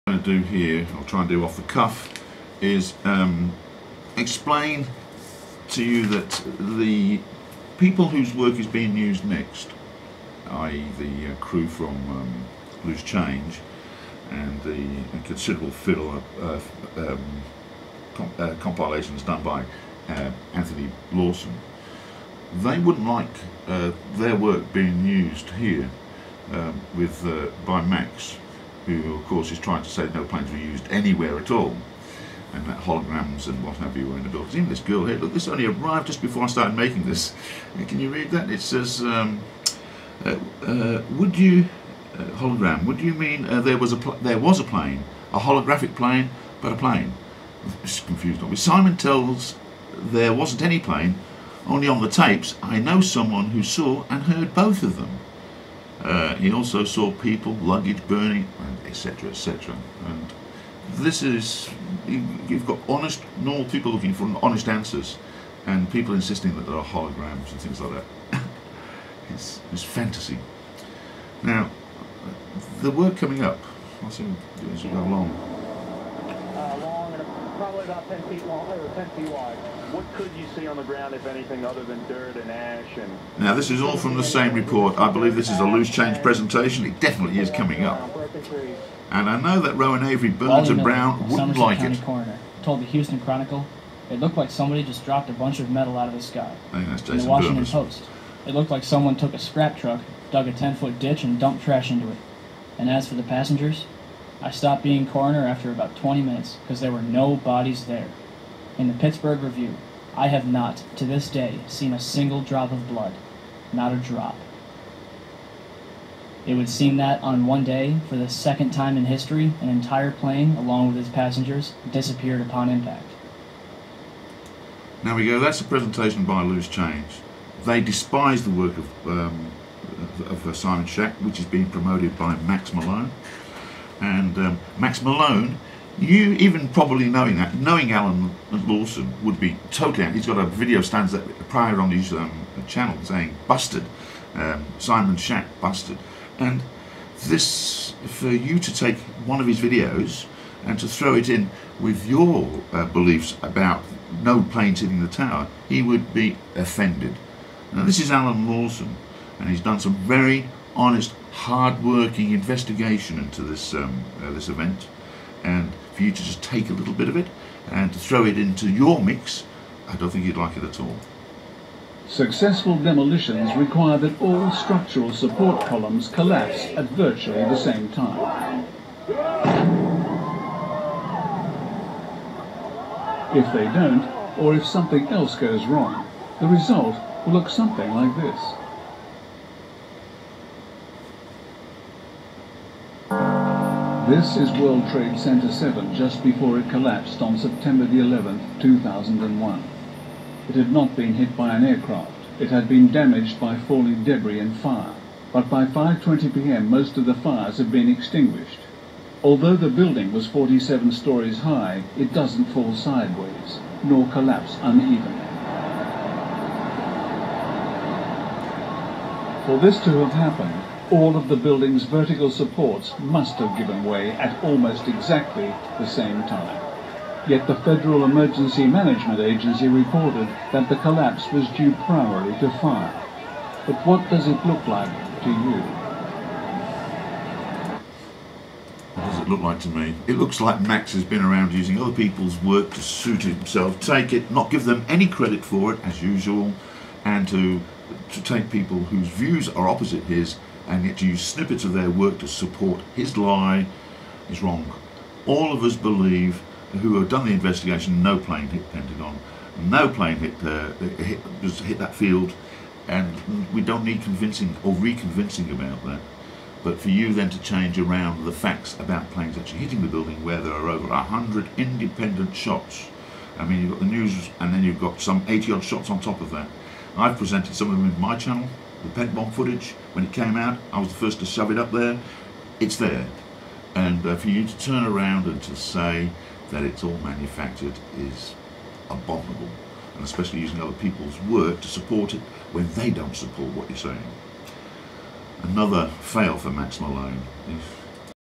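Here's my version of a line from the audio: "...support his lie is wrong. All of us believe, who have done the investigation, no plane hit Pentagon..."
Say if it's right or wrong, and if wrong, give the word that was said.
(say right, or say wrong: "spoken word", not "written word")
right.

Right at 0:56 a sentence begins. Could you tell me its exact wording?
Uh, he also saw people, luggage burning, etc., etc.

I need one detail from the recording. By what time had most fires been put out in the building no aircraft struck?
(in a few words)
5:20 p.m.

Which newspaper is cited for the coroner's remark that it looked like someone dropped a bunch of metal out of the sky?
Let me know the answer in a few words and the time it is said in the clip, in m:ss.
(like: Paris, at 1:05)
Houston Chronicle, at 1:32.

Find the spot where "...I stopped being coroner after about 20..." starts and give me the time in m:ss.
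1:44.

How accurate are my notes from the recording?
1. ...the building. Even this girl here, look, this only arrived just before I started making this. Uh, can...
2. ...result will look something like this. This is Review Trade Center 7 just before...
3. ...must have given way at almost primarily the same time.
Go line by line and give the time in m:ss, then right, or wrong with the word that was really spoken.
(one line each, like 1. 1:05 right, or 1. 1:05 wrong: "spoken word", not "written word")
1. 0:34 right
2. 3:06 wrong: "World", not "Review"
3. 3:42 wrong: "exactly", not "primarily".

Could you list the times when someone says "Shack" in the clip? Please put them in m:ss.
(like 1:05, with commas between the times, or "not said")
2:10, 2:25.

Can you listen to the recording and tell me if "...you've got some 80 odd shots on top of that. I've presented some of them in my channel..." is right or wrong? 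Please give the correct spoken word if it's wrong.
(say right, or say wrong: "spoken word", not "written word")
right.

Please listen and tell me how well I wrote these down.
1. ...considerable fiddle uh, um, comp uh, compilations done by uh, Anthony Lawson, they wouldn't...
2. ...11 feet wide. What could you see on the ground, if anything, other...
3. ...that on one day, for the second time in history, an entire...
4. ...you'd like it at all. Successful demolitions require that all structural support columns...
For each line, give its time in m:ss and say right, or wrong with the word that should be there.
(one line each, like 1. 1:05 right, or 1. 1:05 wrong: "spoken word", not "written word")
1. 0:15 right
2. 1:18 wrong: "10", not "11"
3. 1:56 right
4. 2:50 right.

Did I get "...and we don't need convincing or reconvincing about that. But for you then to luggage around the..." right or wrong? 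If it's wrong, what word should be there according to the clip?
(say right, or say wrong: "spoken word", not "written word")
wrong: "change", not "luggage".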